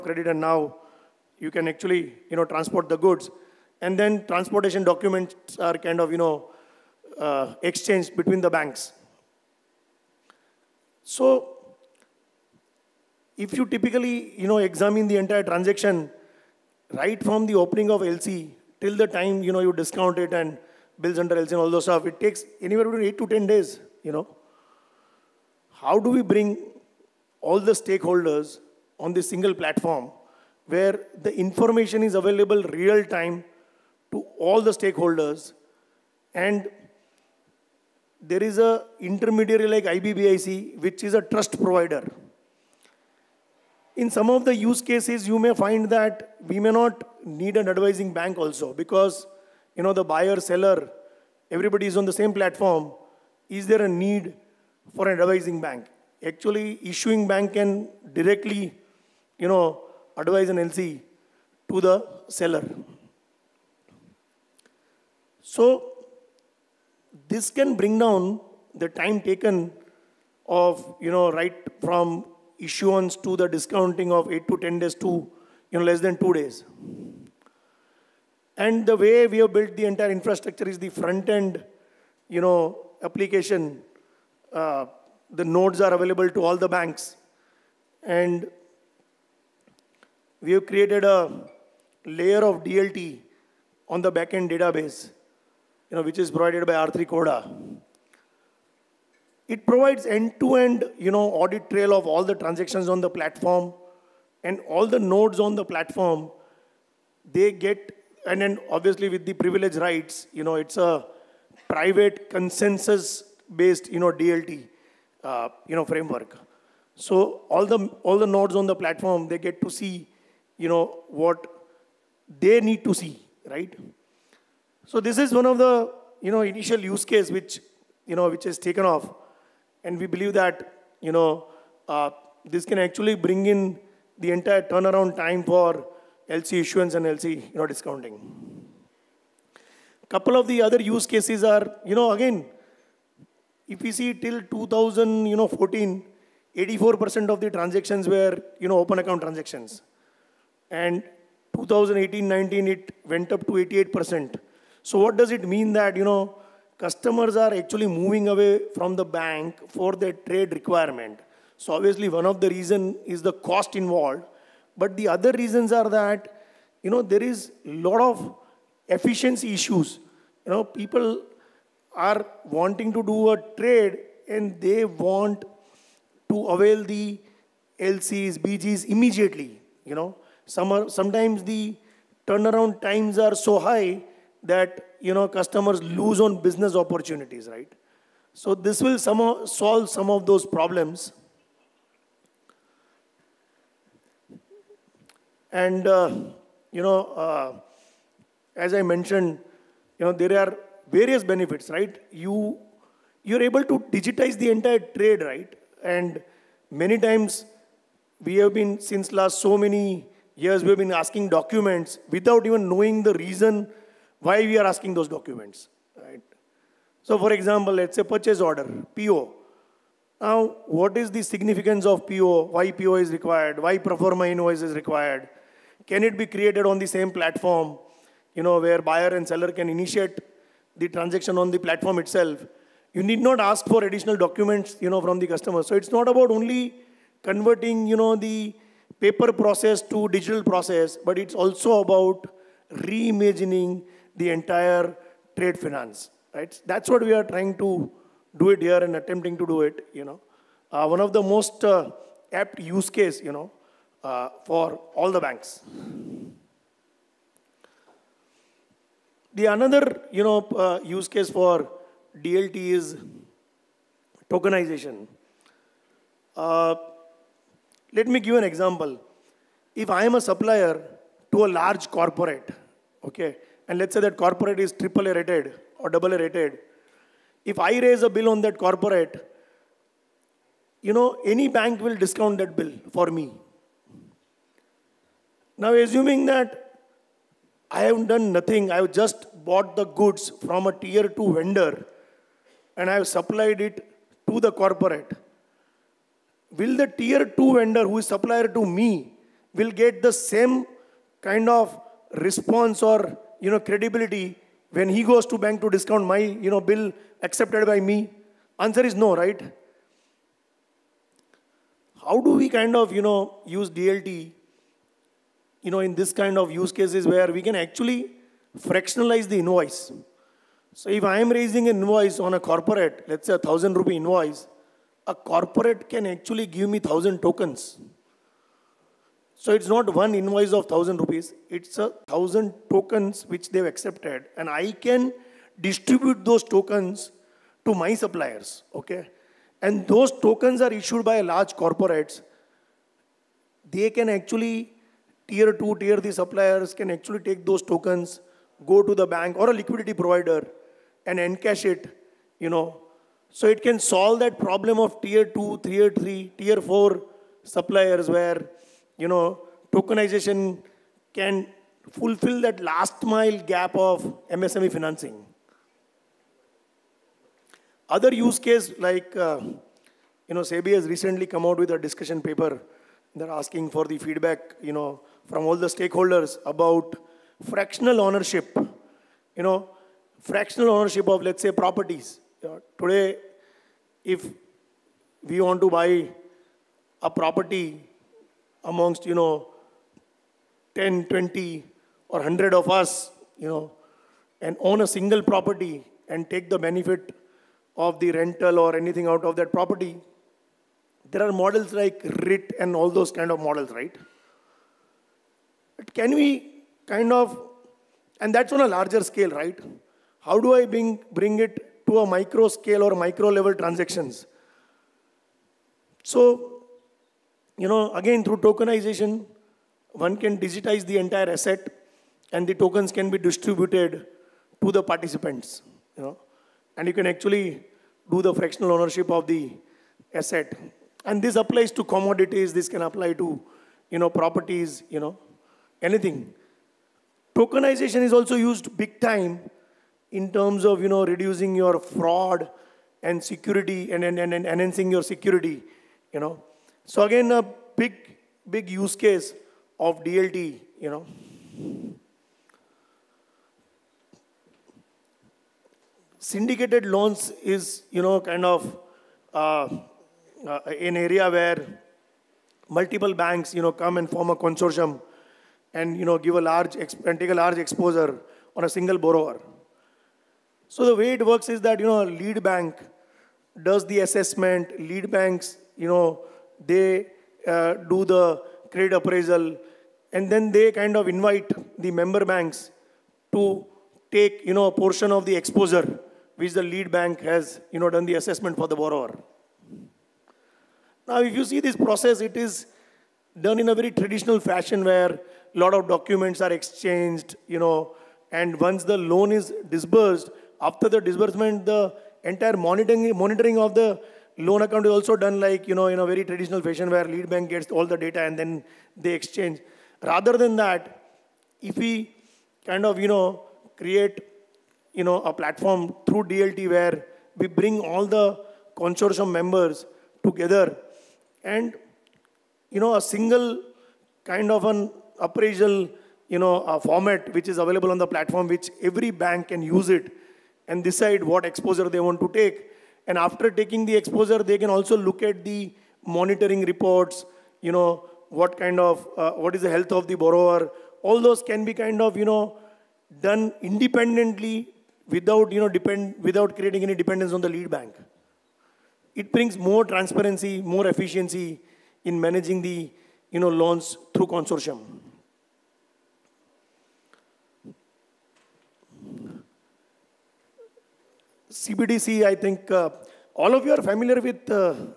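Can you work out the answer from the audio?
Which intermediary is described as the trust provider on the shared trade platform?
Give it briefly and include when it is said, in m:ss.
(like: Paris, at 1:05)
IBBIC, at 0:39.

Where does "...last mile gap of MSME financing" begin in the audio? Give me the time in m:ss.
6:02.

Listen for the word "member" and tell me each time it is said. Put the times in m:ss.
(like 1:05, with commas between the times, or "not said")
8:01, 8:39.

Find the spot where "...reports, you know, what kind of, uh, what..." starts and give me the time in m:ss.
8:56.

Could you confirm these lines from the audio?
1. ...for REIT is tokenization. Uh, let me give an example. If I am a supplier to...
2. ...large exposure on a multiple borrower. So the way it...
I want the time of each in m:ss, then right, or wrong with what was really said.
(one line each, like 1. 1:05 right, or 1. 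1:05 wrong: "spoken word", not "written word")
1. 4:21 wrong: "DLT", not "REIT"
2. 7:47 wrong: "single", not "multiple".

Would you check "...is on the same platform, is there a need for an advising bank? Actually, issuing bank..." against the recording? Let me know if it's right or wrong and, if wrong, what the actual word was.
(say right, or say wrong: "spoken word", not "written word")
right.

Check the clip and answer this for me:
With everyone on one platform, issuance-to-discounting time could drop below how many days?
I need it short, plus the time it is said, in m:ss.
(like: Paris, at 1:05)
2 days, at 1:15.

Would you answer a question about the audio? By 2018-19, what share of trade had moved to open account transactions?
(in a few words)
88%.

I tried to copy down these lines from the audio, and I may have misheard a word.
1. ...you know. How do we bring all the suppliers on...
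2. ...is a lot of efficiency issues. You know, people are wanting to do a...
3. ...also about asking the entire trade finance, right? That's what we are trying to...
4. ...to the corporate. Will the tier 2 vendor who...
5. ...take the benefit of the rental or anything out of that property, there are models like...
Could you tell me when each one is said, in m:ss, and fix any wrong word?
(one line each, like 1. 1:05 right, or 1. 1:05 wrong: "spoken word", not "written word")
1. 0:24 wrong: "stakeholders", not "suppliers"
2. 2:47 right
3. 4:01 wrong: "reimagining", not "asking"
4. 4:54 right
5. 6:36 right.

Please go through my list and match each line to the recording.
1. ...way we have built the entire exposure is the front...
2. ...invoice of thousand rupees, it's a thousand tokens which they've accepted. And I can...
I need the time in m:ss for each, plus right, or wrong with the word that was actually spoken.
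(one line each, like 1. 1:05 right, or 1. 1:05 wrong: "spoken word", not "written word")
1. 1:18 wrong: "infrastructure", not "exposure"
2. 5:30 right.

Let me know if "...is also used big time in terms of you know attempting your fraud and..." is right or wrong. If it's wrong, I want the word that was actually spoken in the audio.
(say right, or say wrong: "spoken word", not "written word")
wrong: "reducing", not "attempting".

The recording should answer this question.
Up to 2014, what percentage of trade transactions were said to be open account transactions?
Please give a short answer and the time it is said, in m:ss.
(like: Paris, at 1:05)
84%, at 2:26.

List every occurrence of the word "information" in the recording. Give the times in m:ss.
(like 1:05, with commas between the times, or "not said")
0:31.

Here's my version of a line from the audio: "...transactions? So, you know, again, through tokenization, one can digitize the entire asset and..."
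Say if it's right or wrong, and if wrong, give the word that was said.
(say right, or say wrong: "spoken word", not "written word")
right.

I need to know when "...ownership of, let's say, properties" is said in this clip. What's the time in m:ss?
6:20.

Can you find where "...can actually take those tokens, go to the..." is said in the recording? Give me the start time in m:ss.
5:46.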